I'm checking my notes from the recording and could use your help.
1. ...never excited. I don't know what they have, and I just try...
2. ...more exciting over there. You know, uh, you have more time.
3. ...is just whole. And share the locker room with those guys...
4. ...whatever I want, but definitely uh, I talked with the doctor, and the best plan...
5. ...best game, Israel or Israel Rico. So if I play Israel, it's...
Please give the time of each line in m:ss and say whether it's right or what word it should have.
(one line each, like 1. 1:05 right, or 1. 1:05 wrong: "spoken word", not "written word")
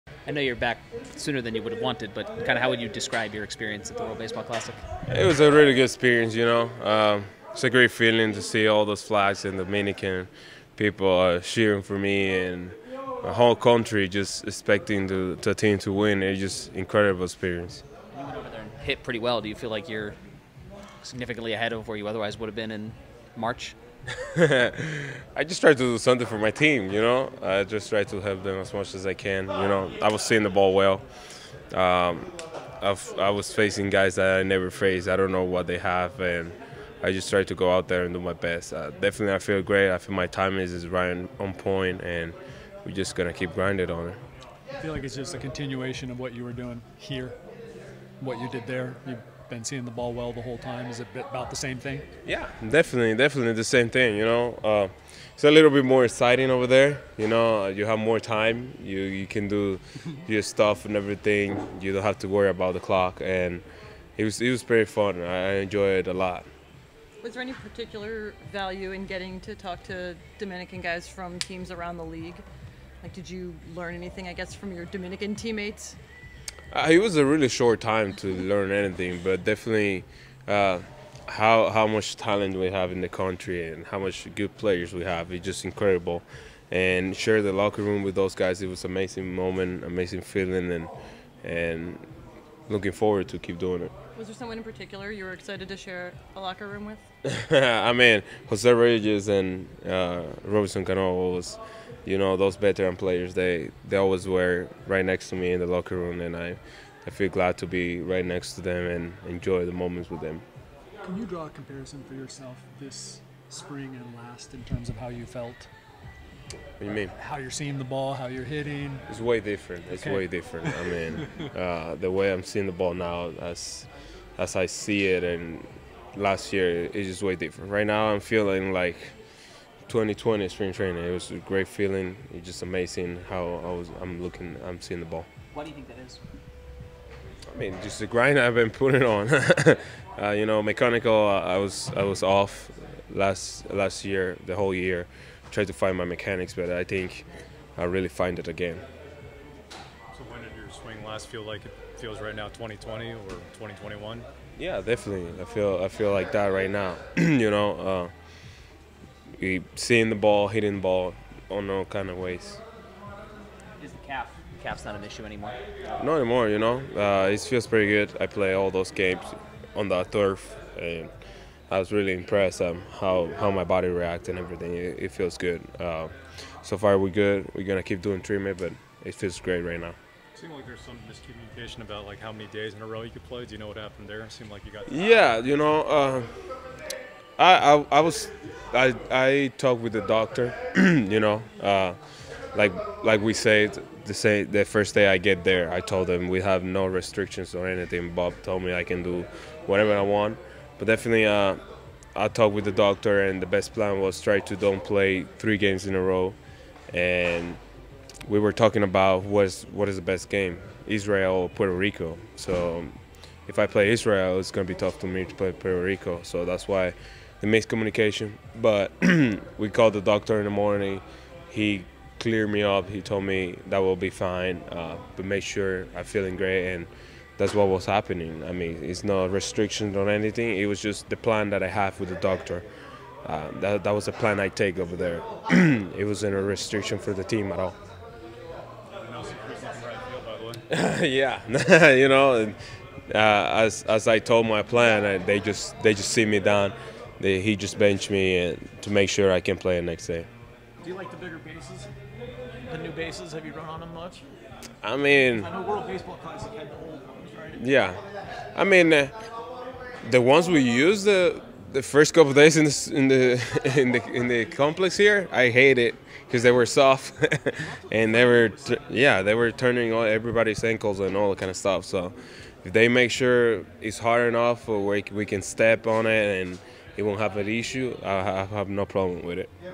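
1. 0:34 wrong: "faced", not "excited"
2. 0:55 right
3. 1:25 wrong: "incredible", not "whole"
4. 3:19 right
5. 3:30 wrong: "Puerto", not "Israel".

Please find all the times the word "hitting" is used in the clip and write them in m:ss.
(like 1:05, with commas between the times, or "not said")
1:58, 2:40.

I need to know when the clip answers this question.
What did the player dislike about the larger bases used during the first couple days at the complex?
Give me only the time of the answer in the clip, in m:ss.
4:26.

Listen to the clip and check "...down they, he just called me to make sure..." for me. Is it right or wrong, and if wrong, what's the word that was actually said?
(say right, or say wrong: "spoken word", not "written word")
wrong: "benched", not "called".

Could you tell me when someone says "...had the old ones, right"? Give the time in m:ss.
4:16.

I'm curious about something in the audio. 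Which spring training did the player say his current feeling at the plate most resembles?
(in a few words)
2020 spring training.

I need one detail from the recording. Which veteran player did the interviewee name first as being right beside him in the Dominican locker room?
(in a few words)
Jose Reyes.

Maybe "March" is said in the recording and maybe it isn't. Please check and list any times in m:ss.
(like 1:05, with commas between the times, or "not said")
0:23.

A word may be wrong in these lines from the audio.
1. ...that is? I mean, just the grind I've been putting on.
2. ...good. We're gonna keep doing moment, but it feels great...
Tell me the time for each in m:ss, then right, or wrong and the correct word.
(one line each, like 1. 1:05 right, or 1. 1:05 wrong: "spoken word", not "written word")
1. 2:15 right
2. 2:57 wrong: "treatment", not "moment".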